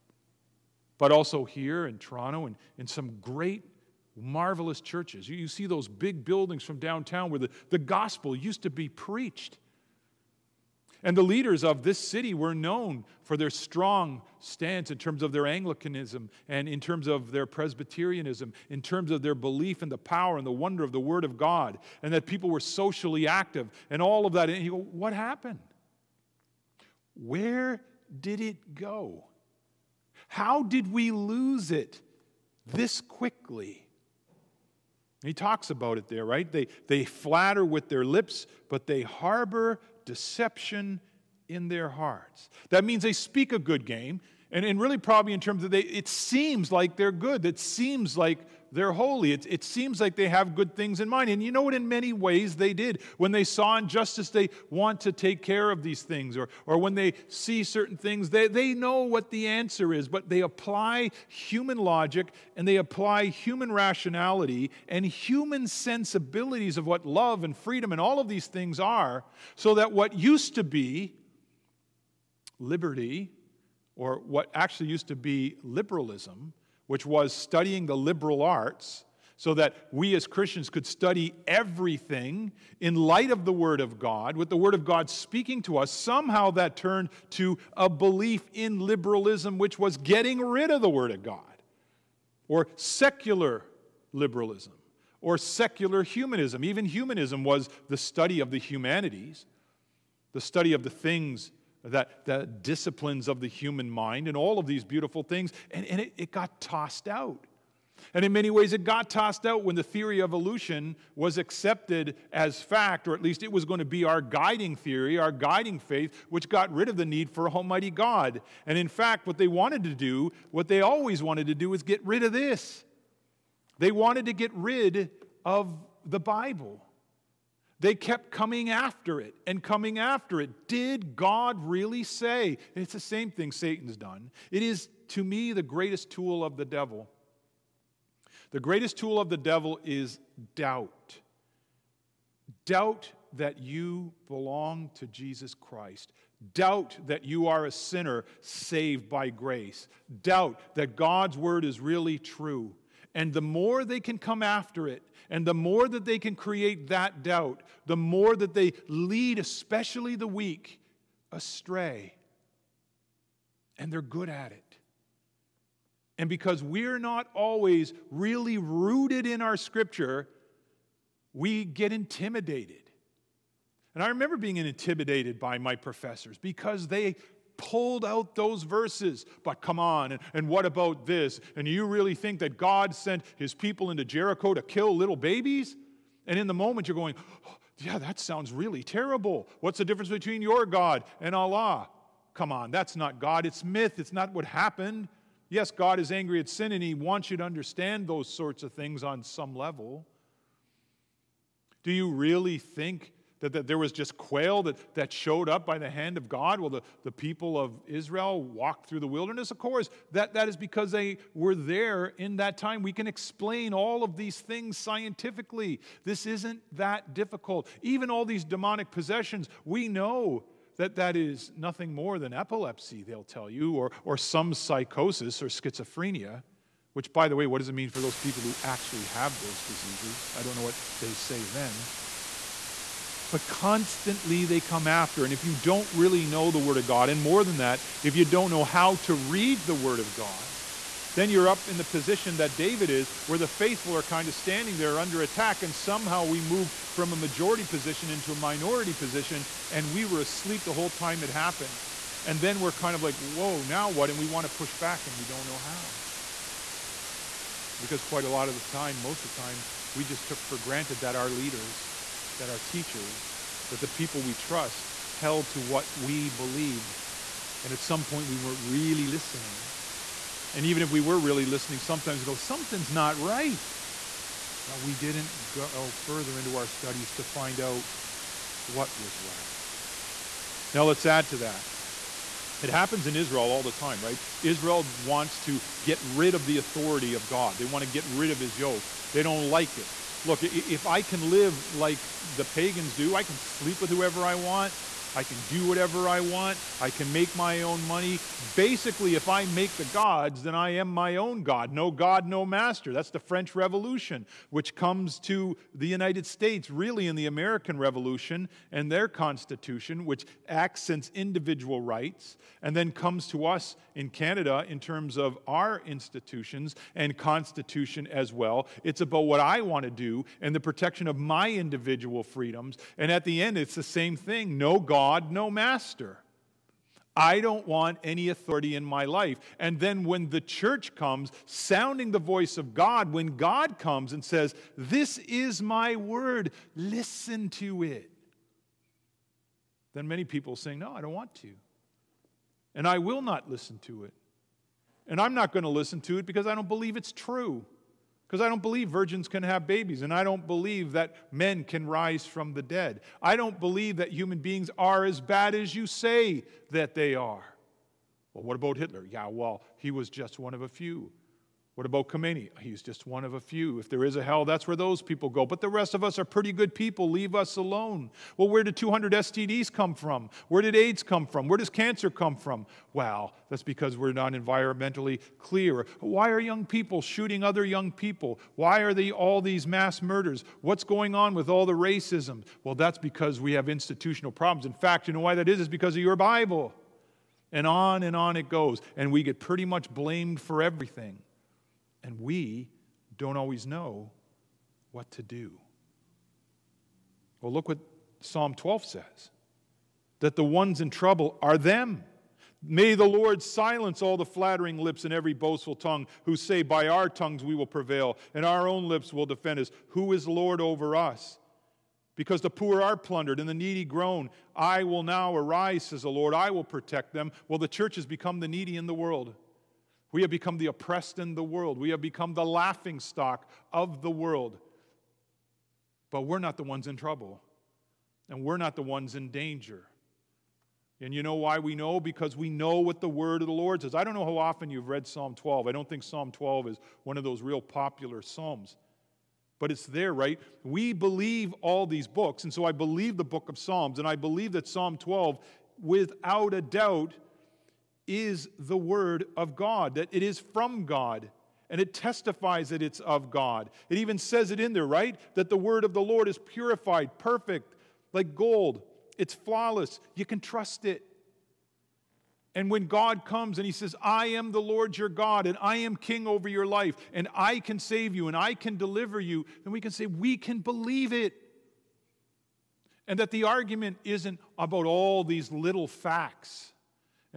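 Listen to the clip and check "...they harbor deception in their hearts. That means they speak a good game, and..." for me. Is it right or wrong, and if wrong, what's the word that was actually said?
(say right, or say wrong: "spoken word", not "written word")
right.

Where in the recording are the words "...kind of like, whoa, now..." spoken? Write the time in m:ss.
4:12.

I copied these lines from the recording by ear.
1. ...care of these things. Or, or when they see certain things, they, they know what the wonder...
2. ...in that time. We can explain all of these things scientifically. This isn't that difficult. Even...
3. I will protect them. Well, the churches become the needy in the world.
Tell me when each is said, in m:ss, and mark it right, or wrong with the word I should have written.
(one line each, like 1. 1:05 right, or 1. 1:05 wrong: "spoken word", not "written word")
1. 0:55 wrong: "answer", not "wonder"
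2. 3:32 right
3. 6:56 right.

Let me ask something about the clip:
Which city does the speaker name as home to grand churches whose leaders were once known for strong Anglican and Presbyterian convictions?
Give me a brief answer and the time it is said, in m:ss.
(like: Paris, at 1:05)
Toronto, at 0:01.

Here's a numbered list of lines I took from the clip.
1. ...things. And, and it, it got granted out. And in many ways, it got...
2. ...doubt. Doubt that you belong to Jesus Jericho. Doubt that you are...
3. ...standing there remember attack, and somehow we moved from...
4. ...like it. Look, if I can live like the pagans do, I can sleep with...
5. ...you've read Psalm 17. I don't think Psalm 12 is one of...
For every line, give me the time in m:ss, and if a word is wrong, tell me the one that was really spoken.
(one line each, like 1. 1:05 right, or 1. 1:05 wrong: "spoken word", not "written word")
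1. 1:45 wrong: "tossed", not "granted"
2. 2:20 wrong: "Christ", not "Jericho"
3. 4:04 wrong: "under", not "remember"
4. 4:49 right
5. 7:14 wrong: "12", not "17".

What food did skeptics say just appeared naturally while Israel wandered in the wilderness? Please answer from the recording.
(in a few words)
Quail.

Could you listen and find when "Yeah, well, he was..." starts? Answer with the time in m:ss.
5:59.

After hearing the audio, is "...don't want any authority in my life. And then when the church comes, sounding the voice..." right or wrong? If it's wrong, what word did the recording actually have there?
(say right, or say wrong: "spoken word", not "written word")
right.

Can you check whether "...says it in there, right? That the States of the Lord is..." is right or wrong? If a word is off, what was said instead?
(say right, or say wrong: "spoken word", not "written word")
wrong: "Word", not "States".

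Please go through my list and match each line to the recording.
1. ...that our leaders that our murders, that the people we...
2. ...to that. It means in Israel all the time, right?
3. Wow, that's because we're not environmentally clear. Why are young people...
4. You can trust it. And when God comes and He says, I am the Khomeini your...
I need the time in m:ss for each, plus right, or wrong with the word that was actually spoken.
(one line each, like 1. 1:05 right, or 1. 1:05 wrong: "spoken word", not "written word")
1. 4:20 wrong: "teachers", not "murders"
2. 4:41 wrong: "happens", not "means"
3. 6:12 right
4. 7:40 wrong: "Lord", not "Khomeini".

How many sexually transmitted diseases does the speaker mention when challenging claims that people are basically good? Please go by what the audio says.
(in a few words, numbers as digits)
200.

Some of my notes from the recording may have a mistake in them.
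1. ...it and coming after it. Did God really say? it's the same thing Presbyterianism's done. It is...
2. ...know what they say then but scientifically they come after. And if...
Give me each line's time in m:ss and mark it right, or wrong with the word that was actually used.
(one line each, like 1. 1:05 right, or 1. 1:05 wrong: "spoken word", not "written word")
1. 2:09 wrong: "Satan", not "Presbyterianism"
2. 3:50 wrong: "constantly", not "scientifically".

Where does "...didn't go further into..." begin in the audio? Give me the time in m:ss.
4:34.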